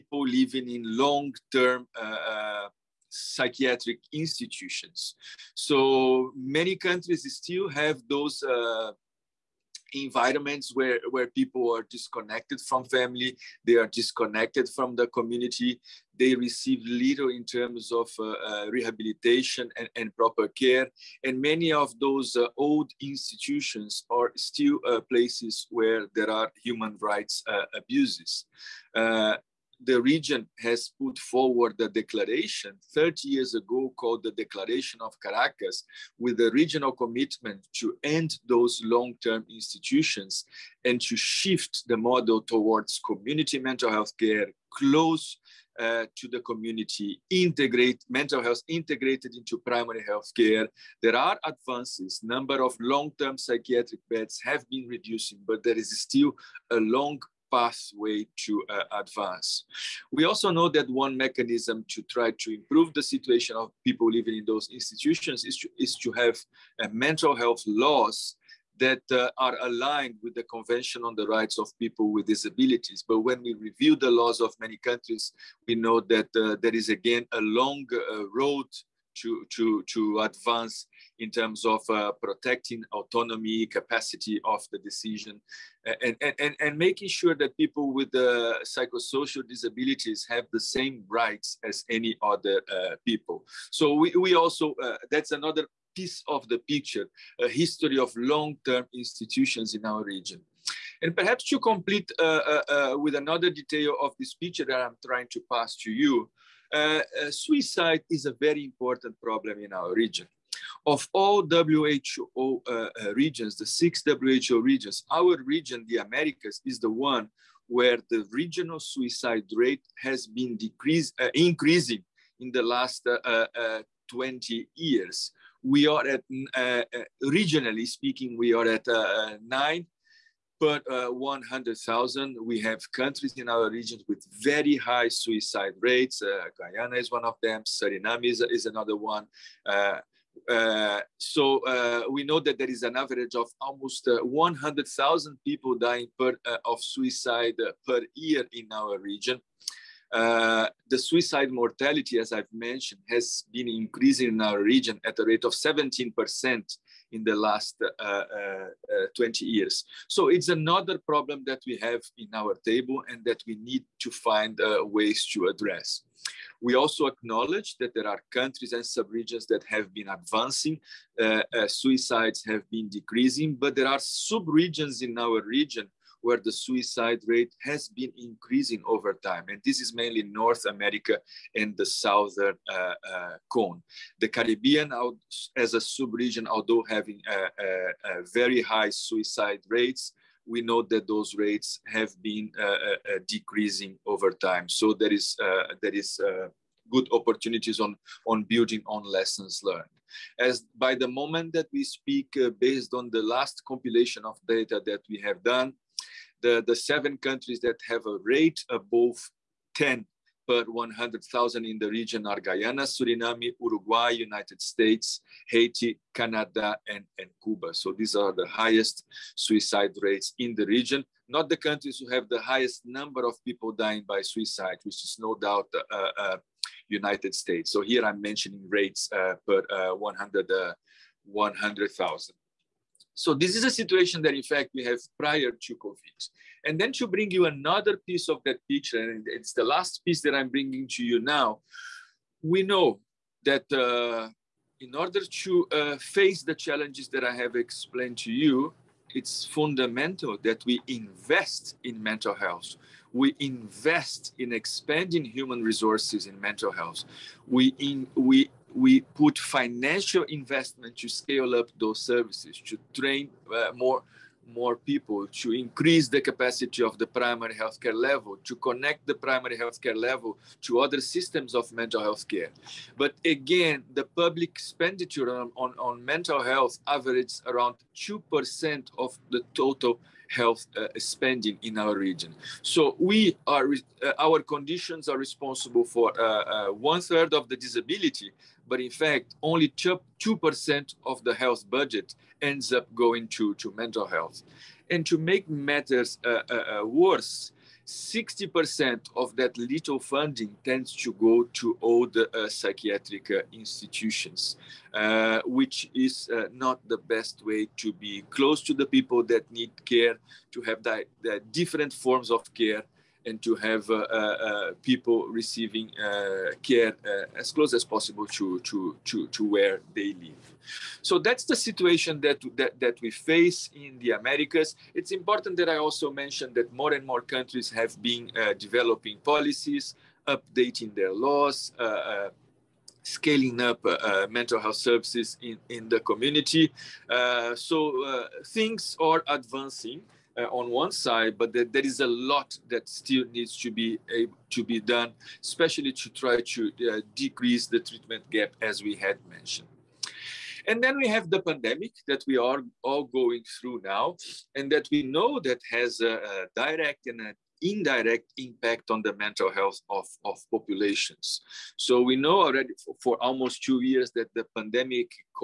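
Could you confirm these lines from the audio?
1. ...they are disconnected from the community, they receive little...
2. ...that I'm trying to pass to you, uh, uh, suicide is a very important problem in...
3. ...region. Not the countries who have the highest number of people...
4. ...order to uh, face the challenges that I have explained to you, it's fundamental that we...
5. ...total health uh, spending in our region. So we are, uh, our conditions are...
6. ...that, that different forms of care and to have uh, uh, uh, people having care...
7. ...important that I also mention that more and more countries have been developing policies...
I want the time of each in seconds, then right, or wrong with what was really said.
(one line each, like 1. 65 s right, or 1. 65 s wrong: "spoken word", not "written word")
1. 13 s right
2. 104 s right
3. 220 s right
4. 244 s right
5. 279 s right
6. 310 s wrong: "receiving", not "having"
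7. 325 s right.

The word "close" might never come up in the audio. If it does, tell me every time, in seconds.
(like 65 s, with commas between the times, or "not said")
44 s, 308 s, 317 s.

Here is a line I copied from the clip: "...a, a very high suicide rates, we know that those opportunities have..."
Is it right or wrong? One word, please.
wrong.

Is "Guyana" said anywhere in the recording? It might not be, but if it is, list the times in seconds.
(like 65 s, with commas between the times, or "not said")
136 s, 212 s.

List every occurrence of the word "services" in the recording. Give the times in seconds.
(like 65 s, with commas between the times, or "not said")
261 s, 334 s.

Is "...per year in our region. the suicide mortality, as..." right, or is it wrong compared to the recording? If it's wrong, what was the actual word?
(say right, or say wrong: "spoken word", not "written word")
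right.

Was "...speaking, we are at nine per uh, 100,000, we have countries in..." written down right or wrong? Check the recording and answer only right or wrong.
right.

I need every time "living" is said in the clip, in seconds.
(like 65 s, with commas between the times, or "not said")
0 s, 64 s.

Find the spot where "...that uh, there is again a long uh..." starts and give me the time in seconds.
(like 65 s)
76 s.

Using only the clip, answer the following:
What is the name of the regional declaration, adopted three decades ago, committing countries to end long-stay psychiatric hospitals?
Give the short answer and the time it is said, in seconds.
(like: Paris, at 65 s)
Declaration of Caracas, at 34 s.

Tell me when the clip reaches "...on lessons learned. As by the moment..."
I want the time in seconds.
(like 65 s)
198 s.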